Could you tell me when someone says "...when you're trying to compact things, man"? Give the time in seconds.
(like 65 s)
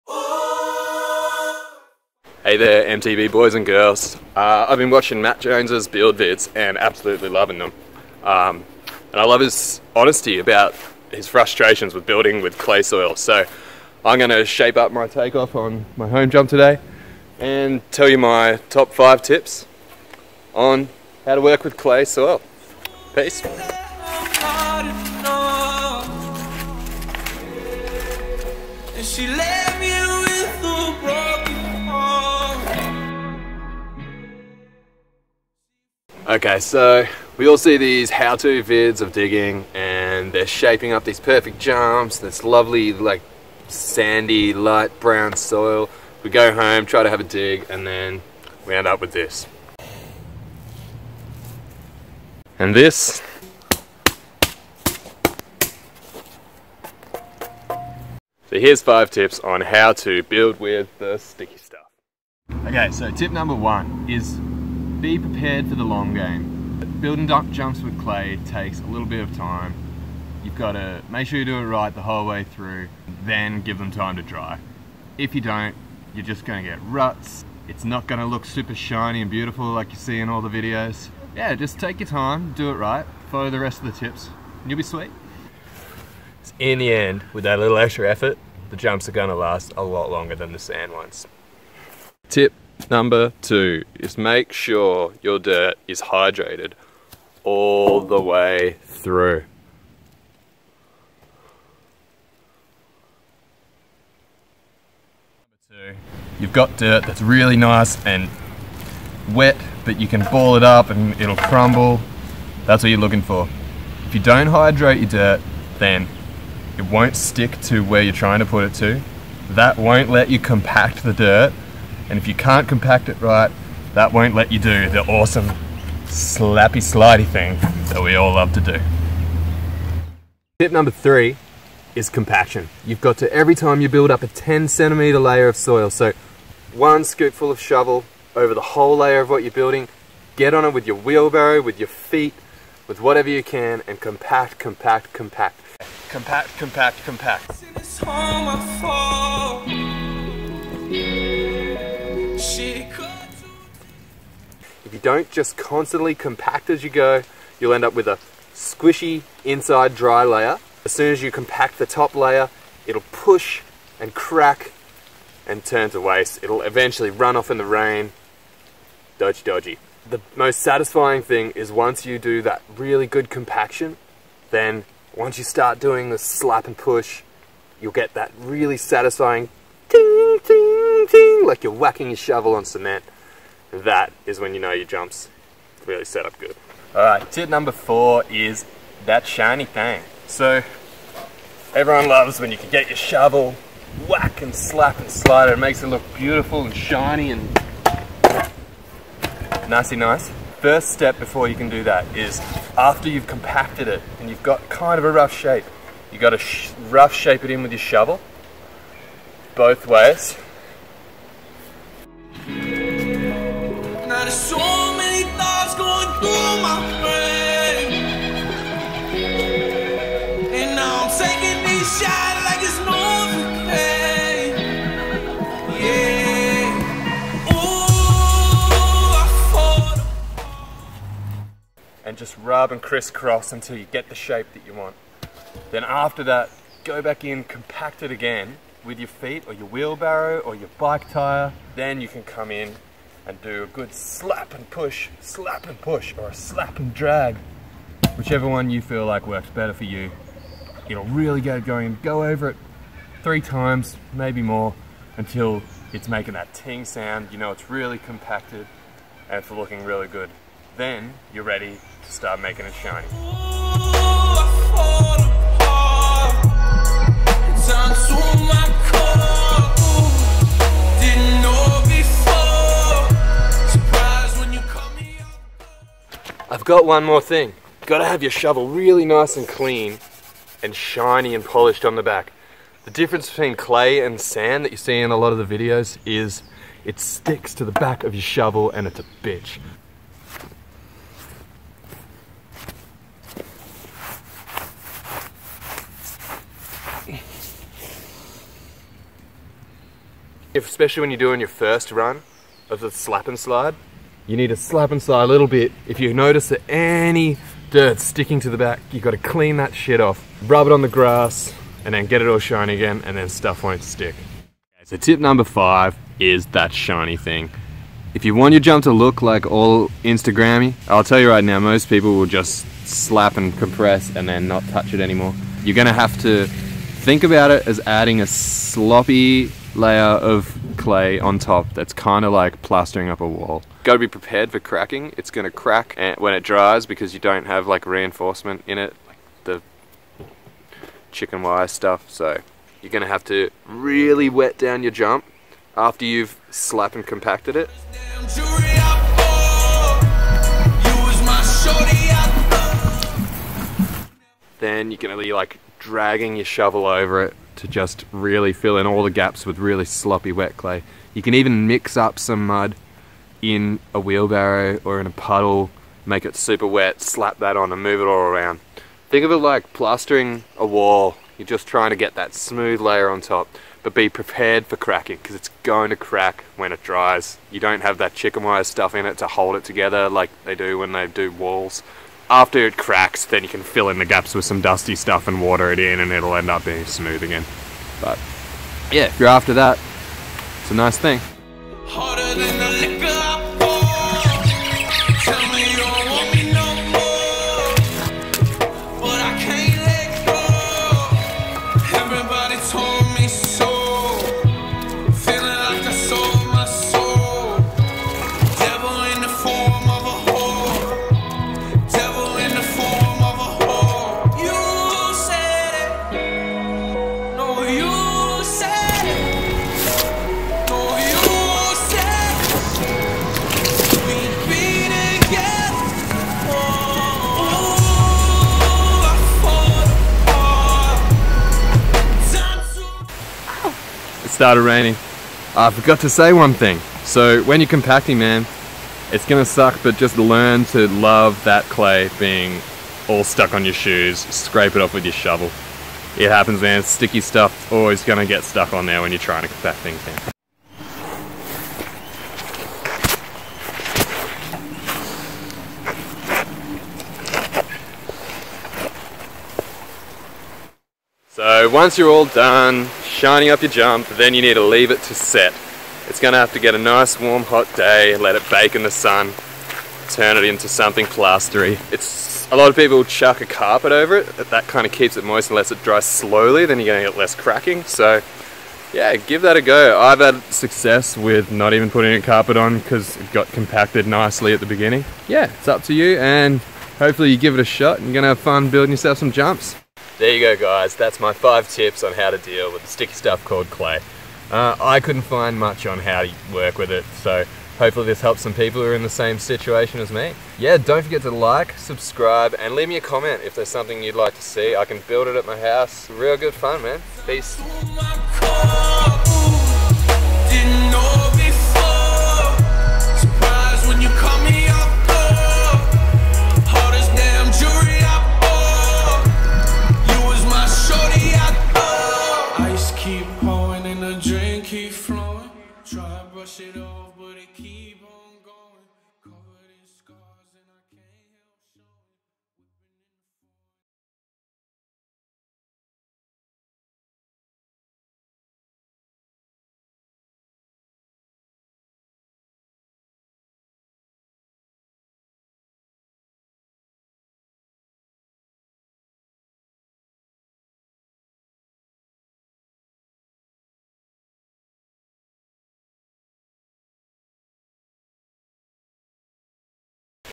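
449 s.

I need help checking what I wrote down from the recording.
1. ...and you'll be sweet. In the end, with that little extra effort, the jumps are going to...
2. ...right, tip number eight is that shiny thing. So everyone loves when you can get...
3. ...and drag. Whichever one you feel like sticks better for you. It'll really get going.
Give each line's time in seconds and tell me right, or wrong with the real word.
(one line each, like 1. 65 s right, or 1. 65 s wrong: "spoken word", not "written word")
1. 84 s right
2. 187 s wrong: "four", not "eight"
3. 246 s wrong: "works", not "sticks".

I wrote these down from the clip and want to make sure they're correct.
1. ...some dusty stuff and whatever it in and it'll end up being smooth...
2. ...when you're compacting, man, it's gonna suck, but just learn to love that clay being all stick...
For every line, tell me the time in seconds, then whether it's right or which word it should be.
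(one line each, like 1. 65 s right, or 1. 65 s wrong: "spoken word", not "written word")
1. 384 s wrong: "water", not "whatever"
2. 437 s wrong: "stuck", not "stick".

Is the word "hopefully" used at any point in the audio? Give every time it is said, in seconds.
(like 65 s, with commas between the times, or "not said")
486 s, 497 s.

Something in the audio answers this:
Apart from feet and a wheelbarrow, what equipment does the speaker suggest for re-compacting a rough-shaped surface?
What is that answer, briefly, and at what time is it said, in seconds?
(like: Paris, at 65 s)
bike tire, at 240 s.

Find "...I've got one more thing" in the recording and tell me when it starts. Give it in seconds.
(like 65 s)
276 s.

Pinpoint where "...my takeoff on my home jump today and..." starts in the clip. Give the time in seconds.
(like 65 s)
14 s.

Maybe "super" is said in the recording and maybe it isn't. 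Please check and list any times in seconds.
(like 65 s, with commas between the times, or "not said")
78 s, 366 s.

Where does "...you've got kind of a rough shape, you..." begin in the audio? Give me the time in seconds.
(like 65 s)
204 s.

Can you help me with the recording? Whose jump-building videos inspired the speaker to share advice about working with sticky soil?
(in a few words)
Matt Jones.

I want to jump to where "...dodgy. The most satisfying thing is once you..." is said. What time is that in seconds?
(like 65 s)
169 s.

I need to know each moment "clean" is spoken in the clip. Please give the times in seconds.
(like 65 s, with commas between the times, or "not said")
279 s, 309 s.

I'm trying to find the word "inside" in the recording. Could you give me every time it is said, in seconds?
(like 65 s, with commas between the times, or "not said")
159 s.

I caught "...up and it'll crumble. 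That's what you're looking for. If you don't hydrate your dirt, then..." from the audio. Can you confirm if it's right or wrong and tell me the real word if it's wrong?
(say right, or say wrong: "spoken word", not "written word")
right.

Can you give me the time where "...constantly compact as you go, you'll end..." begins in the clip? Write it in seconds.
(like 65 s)
155 s.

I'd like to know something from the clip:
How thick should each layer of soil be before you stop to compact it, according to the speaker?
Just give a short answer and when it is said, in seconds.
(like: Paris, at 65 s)
10 centimeters, at 134 s.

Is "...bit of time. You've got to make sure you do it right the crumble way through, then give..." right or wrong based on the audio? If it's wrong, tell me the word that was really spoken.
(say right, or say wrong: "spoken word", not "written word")
wrong: "whole", not "crumble".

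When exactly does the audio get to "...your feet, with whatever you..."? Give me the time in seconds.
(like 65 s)
141 s.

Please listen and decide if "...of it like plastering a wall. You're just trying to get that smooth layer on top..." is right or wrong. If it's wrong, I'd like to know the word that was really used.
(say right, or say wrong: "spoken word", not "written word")
right.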